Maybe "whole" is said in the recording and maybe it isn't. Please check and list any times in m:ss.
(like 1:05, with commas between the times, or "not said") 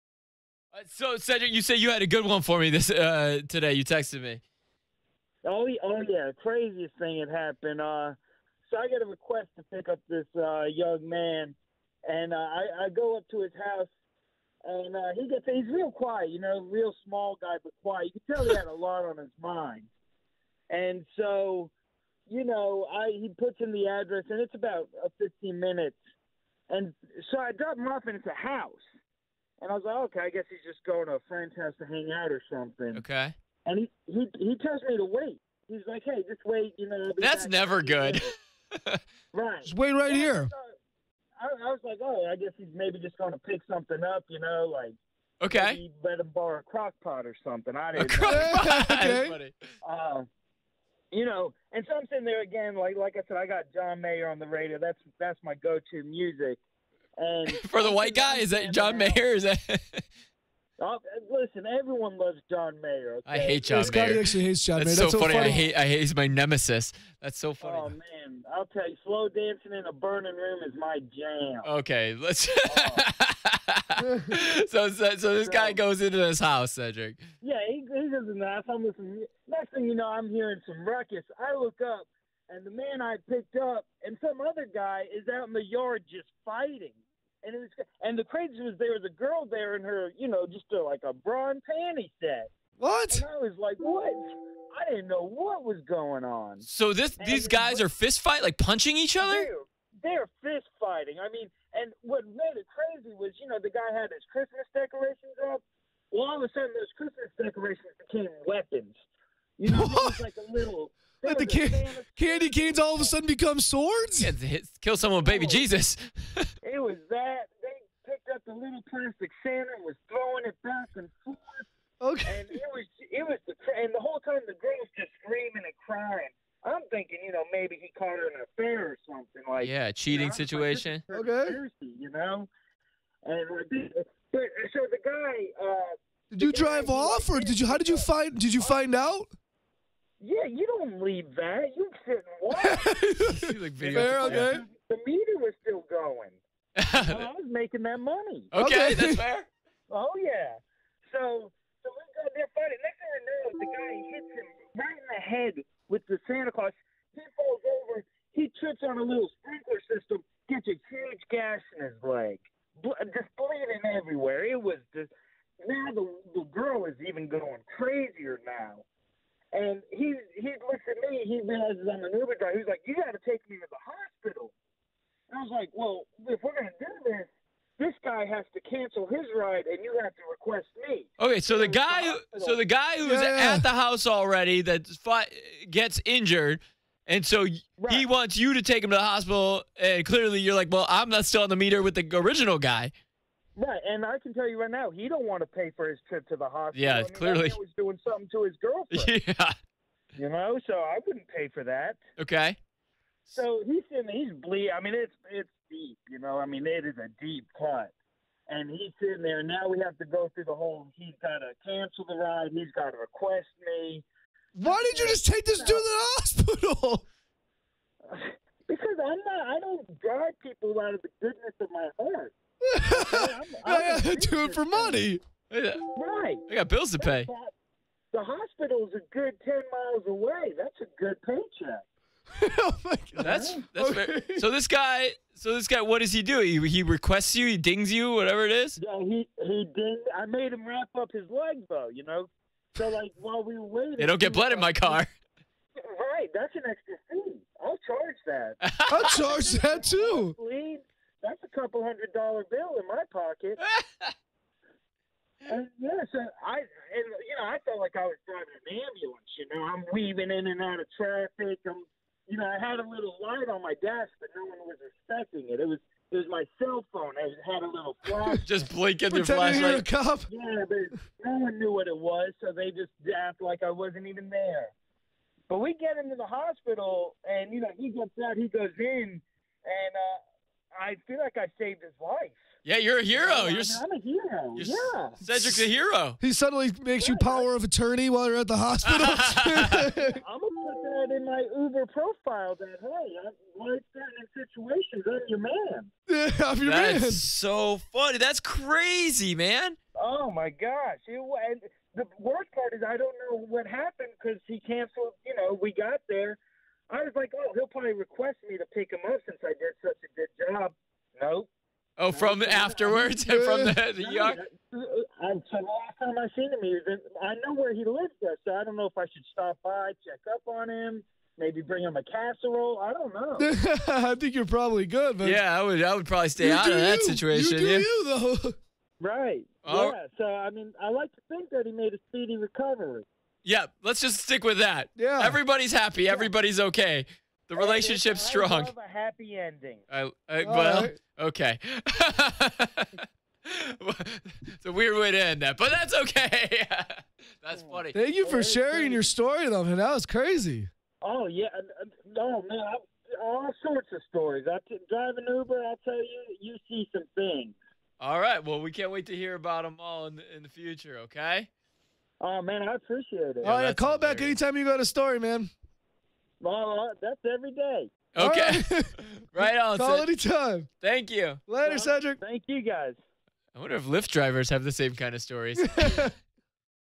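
2:04, 3:30.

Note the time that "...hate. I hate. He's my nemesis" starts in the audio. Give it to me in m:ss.
1:05.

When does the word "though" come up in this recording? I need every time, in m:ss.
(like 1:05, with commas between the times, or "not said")
4:01, 5:28, 5:49.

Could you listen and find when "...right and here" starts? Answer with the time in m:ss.
0:39.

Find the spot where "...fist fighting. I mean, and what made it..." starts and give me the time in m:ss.
1:40.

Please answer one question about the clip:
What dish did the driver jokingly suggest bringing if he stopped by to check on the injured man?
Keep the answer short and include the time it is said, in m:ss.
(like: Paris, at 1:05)
casserole, at 5:22.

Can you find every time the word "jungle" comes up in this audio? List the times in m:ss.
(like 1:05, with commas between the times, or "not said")
not said.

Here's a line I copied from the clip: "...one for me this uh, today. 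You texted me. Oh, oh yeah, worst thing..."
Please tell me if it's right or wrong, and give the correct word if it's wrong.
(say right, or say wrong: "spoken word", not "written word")
wrong: "craziest", not "worst".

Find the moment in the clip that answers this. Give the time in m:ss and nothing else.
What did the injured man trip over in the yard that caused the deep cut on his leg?
2:39.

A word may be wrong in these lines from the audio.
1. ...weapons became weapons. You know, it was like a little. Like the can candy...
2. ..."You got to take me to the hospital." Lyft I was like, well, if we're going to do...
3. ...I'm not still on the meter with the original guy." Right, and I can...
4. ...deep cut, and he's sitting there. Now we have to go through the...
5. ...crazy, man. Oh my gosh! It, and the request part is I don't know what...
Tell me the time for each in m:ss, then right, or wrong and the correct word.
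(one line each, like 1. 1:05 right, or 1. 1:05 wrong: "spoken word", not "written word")
1. 1:47 wrong: "decorations", not "weapons"
2. 2:52 wrong: "And", not "Lyft"
3. 3:10 right
4. 3:27 right
5. 4:58 wrong: "worst", not "request".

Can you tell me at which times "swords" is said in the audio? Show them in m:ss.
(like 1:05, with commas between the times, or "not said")
1:53.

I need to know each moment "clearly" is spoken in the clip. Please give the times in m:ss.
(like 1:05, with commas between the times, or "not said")
3:10, 3:17.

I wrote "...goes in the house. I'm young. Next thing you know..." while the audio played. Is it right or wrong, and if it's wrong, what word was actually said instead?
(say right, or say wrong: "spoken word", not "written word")
wrong: "listening", not "young".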